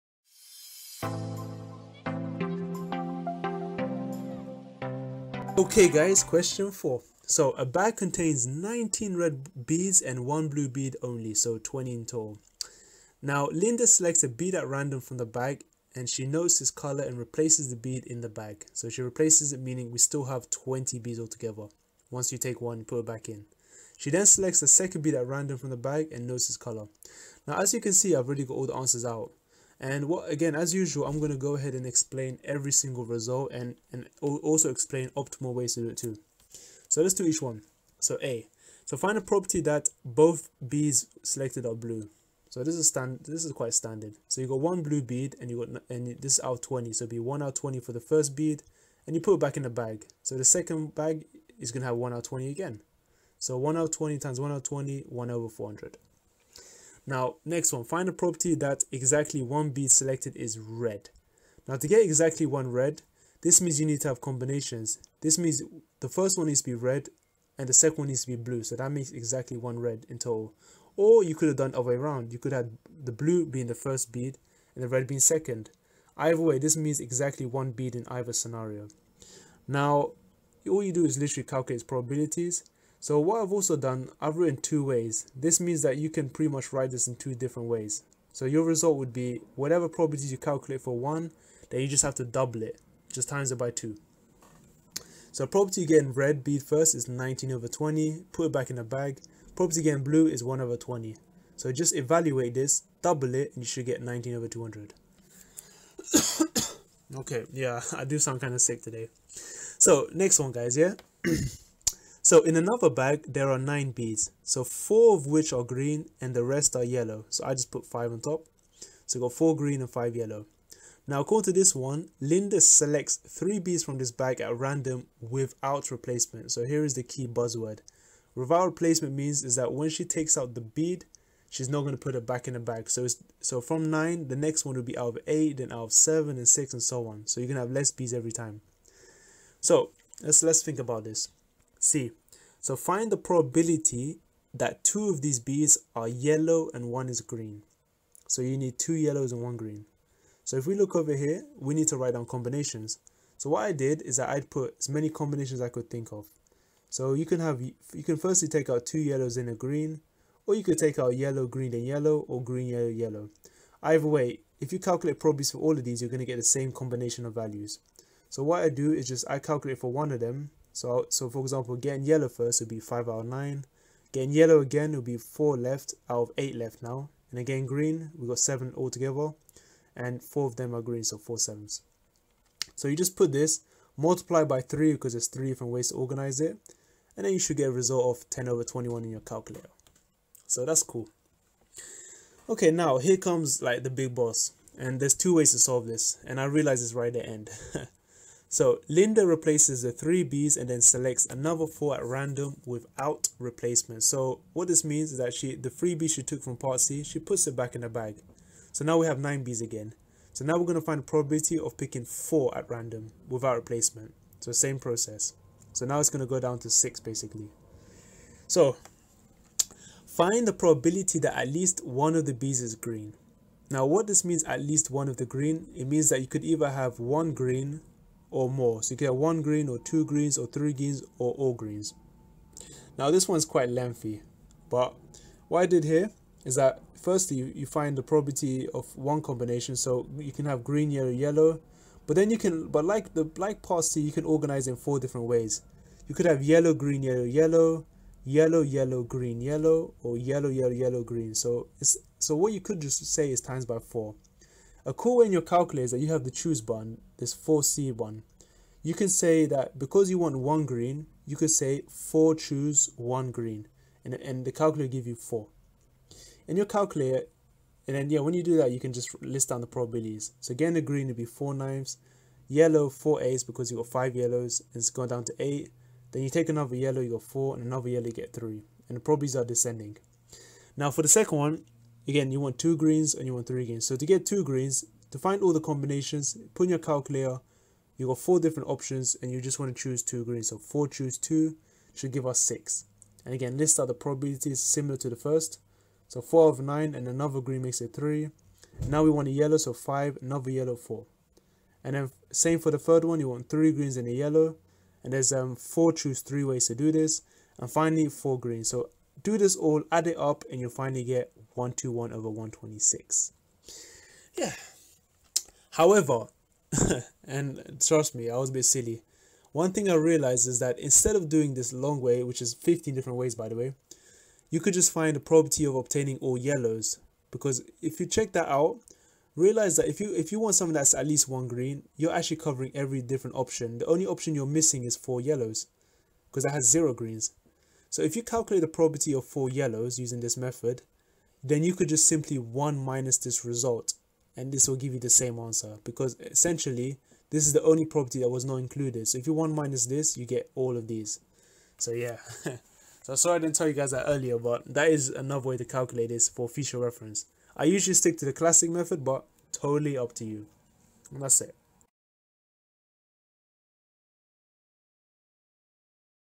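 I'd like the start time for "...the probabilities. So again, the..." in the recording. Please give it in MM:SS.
04:29.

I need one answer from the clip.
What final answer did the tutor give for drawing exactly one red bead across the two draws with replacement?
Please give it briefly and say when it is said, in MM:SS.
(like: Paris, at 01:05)
19/200, at 01:44.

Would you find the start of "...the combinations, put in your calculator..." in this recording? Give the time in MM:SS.
04:45.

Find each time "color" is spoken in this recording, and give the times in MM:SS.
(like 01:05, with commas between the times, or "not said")
00:16, 00:26.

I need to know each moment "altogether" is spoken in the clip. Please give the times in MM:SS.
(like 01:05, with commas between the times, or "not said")
00:21, 02:58.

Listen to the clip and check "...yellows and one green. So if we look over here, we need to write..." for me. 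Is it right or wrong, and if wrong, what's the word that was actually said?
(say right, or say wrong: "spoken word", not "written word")
right.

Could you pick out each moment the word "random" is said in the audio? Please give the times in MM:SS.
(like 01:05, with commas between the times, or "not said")
00:14, 00:25, 02:04, 03:22, 03:32.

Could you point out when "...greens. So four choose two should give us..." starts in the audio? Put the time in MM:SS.
04:50.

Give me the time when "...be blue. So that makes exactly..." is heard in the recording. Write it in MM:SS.
01:08.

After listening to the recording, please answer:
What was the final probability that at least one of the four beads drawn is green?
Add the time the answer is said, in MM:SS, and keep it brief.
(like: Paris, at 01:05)
121/126, at 05:11.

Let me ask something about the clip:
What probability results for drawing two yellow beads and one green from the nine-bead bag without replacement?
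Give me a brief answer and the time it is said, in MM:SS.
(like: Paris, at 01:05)
10/21, at 03:08.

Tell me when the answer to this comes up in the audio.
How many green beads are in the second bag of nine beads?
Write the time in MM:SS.
01:54.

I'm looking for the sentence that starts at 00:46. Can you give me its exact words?
So be one out twenty for the first bead, and you put it back in the bag.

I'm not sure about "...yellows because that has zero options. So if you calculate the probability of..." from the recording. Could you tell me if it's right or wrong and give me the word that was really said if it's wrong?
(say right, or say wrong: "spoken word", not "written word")
wrong: "greens", not "options".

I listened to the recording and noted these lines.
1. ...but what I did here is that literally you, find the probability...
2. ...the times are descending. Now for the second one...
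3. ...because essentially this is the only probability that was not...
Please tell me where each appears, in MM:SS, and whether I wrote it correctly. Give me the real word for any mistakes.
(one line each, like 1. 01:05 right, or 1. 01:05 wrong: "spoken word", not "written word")
1. 03:54 wrong: "firstly", not "literally"
2. 04:38 wrong: "probabilities", not "times"
3. 05:45 right.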